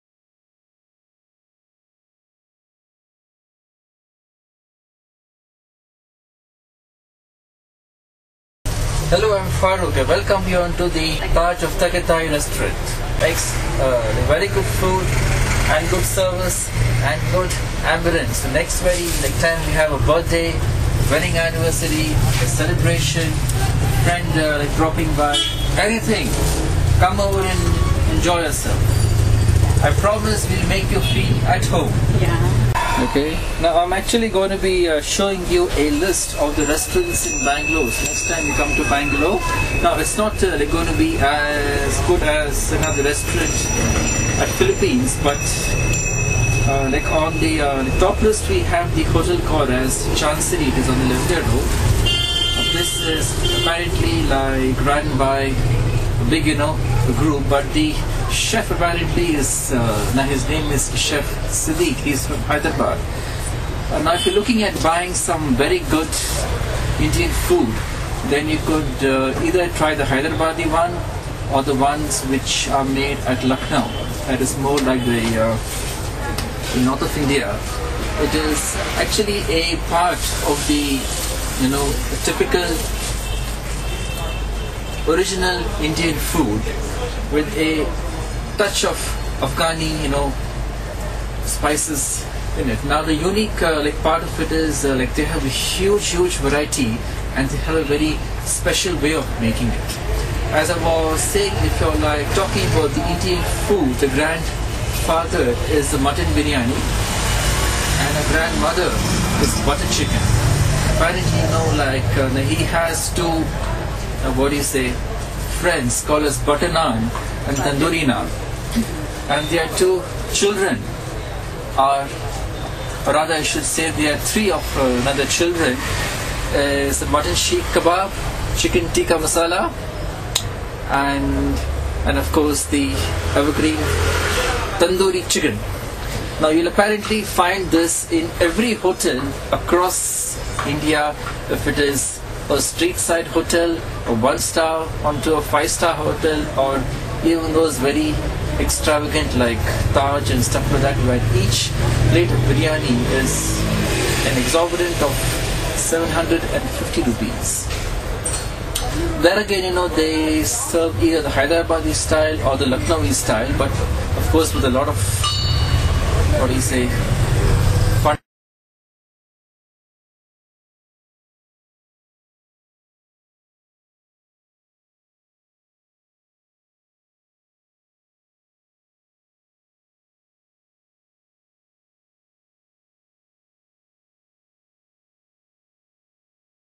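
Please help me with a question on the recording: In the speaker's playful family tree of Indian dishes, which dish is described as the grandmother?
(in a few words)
butter chicken.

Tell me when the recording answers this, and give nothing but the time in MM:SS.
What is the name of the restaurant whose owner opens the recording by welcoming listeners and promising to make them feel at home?
00:11.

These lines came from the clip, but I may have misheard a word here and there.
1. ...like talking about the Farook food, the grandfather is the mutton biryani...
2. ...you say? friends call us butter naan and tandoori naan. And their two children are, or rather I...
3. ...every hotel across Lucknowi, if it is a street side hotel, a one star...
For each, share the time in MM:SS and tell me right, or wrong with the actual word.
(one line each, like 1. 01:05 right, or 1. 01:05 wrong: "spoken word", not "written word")
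1. 01:41 wrong: "Indian", not "Farook"
2. 01:54 right
3. 02:18 wrong: "India", not "Lucknowi".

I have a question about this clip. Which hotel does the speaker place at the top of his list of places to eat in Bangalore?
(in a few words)
Chancery.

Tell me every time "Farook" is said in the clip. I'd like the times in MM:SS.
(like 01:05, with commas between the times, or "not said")
00:09.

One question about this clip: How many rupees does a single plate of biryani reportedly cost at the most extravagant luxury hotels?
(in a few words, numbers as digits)
750 rupees.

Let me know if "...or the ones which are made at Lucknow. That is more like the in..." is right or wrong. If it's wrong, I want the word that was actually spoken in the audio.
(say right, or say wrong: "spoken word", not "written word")
right.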